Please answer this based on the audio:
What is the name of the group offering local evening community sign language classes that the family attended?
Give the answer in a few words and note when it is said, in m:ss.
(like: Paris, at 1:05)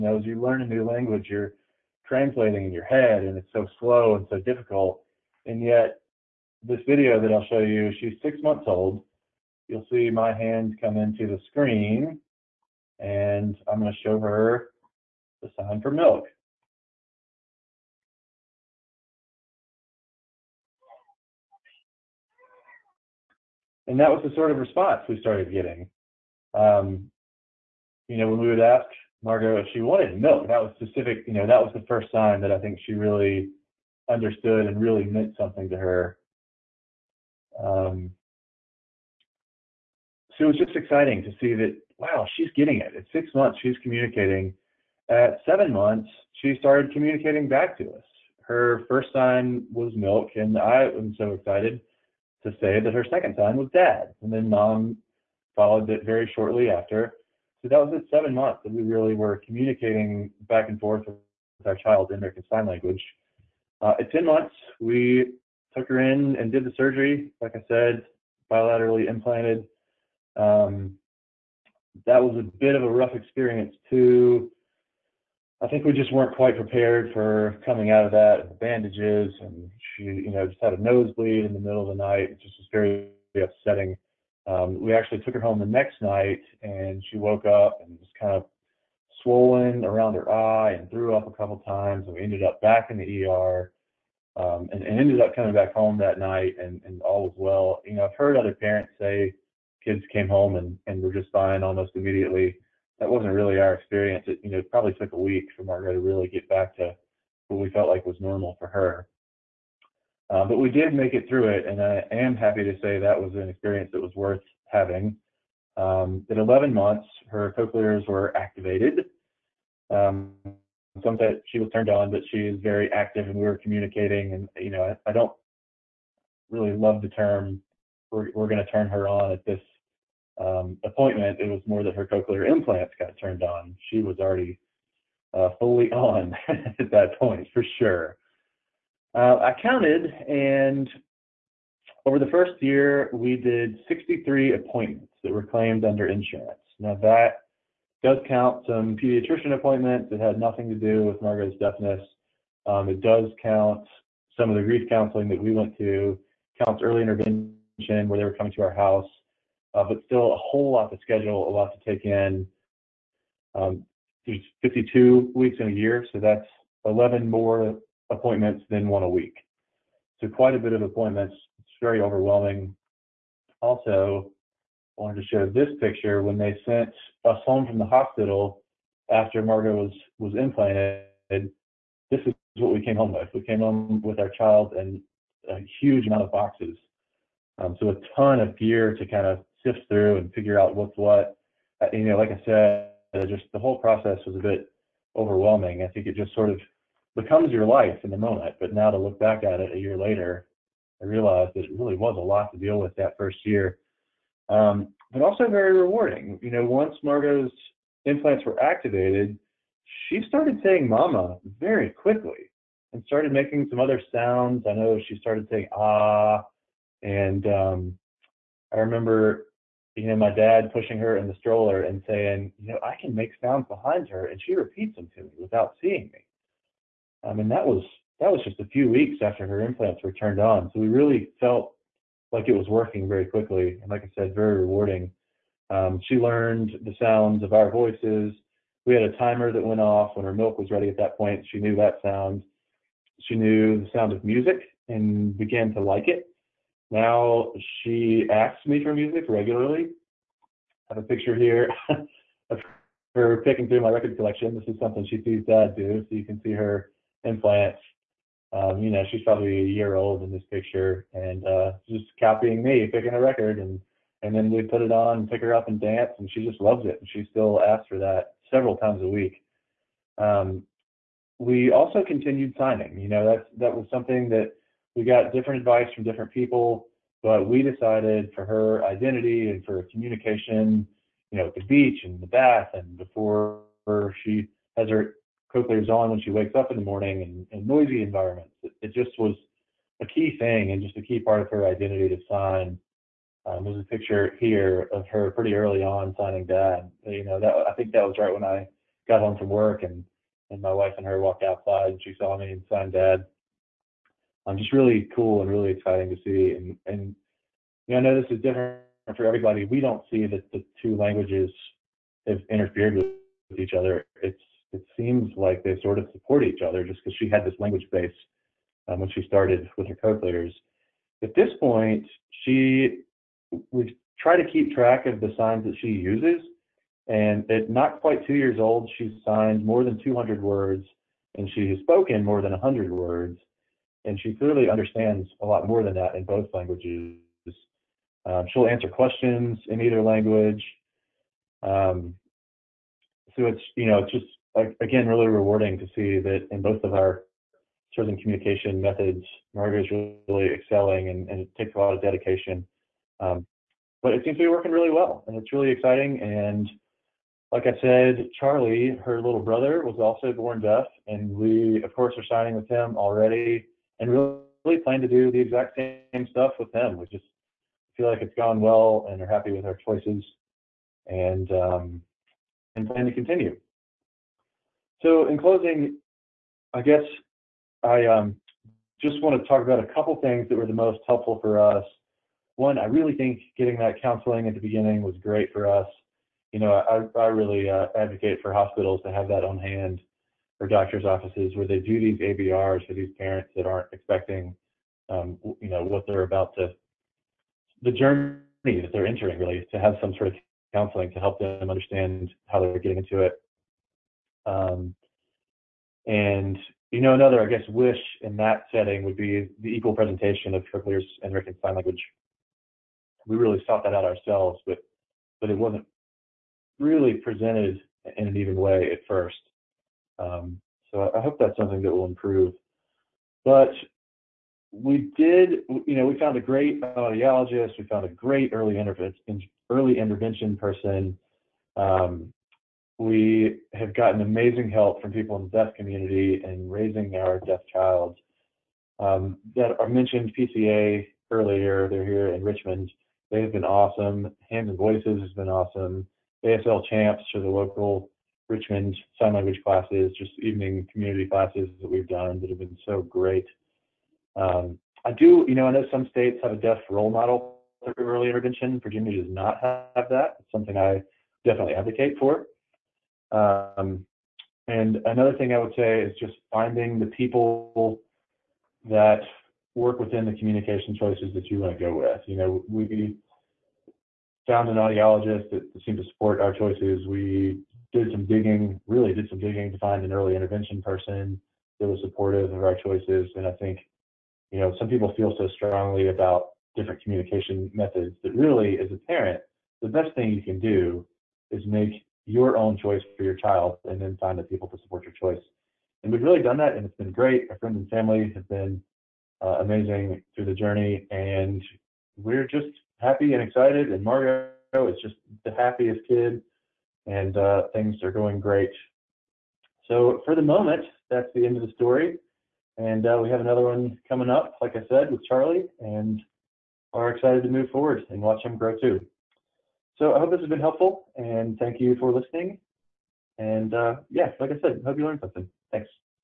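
ASL Champs, at 7:26.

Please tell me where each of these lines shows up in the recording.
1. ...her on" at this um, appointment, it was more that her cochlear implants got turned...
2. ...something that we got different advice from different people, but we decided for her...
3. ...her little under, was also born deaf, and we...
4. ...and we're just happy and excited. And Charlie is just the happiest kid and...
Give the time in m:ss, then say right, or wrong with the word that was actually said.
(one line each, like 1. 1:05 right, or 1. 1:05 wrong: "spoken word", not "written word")
1. 2:08 right
2. 4:33 right
3. 5:59 wrong: "brother", not "under"
4. 8:21 wrong: "Margot", not "Charlie".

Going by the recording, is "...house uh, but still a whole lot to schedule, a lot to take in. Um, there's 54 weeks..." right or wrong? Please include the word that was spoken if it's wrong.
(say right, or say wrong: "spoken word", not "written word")
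wrong: "52", not "54".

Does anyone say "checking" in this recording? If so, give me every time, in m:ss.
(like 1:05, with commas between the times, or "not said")
not said.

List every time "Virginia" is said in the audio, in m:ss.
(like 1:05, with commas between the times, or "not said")
7:38.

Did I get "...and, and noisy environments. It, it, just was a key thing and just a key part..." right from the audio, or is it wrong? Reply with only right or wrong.
right.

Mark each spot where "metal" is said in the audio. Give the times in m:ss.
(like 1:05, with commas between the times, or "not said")
not said.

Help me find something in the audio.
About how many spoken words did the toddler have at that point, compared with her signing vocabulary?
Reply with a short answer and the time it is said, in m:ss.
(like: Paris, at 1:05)
more than 100, at 5:32.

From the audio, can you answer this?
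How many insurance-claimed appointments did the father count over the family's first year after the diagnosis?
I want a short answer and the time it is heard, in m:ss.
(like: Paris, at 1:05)
63, at 2:23.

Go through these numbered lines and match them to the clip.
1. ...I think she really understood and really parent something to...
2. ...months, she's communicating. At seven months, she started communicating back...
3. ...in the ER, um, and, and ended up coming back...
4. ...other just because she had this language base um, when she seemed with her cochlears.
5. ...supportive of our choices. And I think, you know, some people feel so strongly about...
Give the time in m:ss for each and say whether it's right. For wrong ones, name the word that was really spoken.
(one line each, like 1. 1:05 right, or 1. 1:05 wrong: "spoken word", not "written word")
1. 0:32 wrong: "meant", not "parent"
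2. 0:43 right
3. 1:32 right
4. 5:16 wrong: "started", not "seemed"
5. 8:02 right.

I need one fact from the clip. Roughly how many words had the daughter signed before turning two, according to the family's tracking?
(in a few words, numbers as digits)
more than 200.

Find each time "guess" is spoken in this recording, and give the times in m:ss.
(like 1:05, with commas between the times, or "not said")
6:16, 6:47.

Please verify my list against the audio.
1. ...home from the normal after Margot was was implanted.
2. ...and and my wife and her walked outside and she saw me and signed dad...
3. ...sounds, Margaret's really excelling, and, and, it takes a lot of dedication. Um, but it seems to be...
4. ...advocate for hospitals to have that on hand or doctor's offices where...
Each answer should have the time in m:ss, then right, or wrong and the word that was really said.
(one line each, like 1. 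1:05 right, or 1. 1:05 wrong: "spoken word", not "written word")
1. 2:57 wrong: "hospital", not "normal"
2. 4:59 right
3. 5:48 wrong: "methods", not "sounds"
4. 6:27 right.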